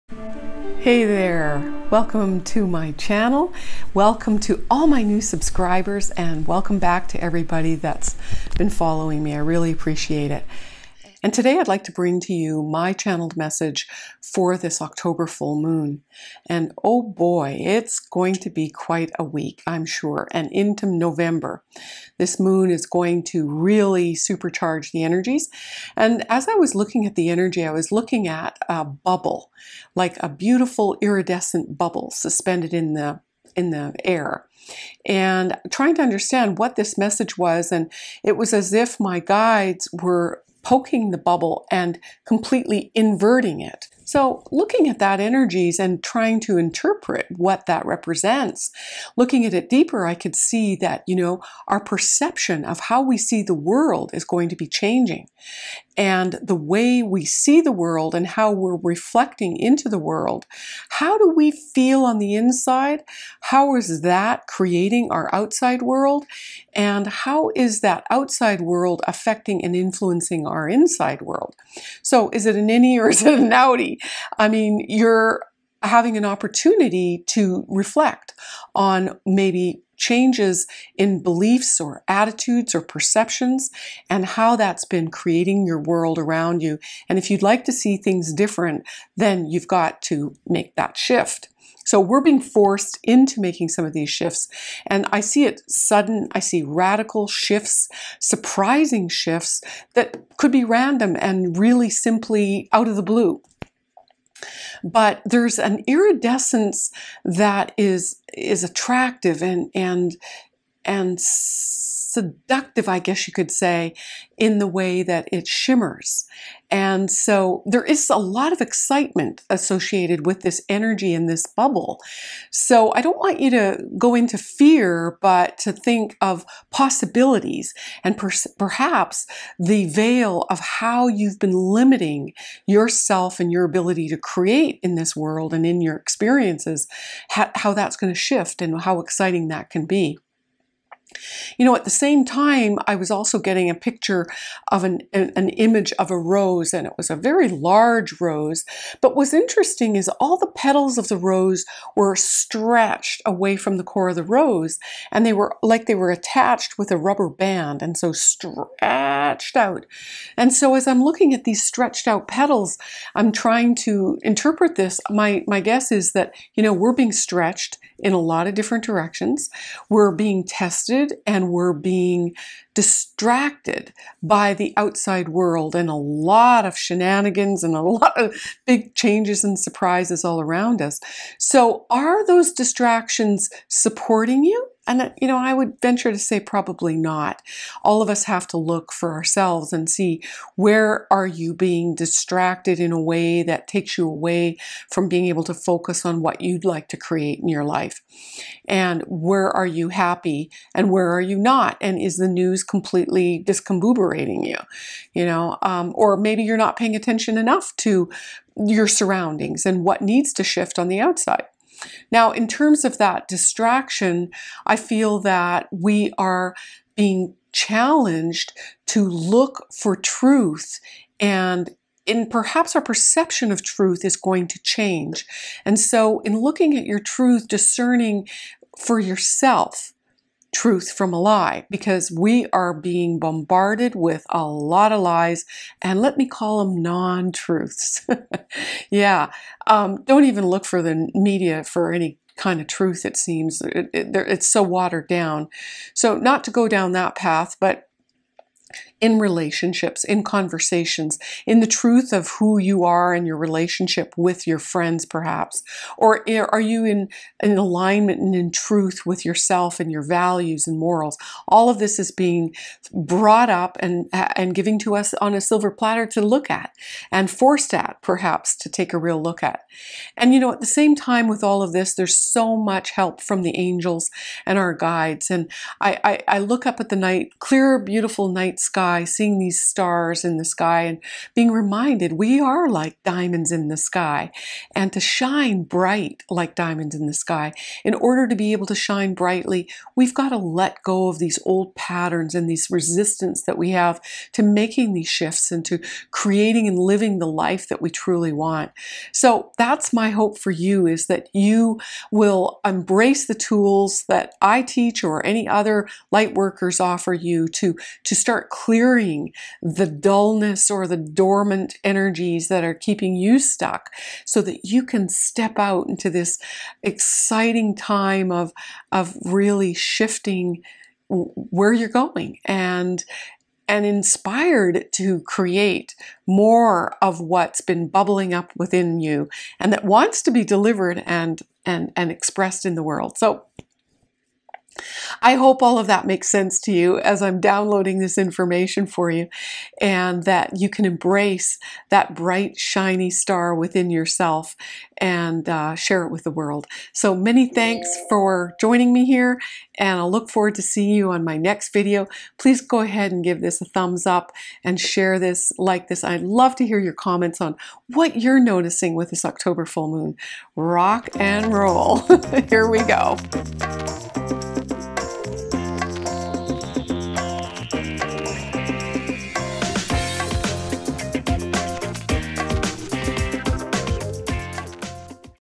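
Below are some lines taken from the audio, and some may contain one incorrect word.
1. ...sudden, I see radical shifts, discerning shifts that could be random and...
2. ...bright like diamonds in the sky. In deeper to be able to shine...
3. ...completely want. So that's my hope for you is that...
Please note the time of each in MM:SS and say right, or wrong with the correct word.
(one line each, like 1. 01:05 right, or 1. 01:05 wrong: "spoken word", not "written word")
1. 01:35 wrong: "surprising", not "discerning"
2. 04:45 wrong: "order", not "deeper"
3. 04:57 wrong: "truly", not "completely".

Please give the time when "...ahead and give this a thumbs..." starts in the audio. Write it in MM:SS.
05:52.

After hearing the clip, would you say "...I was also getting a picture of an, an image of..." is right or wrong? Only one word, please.
right.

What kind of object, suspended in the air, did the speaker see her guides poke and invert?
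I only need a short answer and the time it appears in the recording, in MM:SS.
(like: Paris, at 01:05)
iridescent bubble, at 00:31.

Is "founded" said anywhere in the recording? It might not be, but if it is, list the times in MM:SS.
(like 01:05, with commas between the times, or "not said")
not said.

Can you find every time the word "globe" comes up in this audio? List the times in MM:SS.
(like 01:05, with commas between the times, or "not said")
not said.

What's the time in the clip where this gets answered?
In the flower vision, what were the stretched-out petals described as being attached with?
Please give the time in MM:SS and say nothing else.
02:36.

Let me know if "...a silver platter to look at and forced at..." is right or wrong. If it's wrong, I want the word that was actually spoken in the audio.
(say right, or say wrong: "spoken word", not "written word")
right.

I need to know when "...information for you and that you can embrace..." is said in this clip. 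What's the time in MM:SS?
05:38.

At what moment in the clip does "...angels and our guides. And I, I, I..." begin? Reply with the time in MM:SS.
04:33.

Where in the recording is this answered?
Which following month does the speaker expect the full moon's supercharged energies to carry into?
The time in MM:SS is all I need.
00:20.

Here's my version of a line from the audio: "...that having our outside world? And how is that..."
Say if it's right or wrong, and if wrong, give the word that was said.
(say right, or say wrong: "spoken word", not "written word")
wrong: "creating", not "having".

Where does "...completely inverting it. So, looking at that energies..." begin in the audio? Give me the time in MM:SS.
00:42.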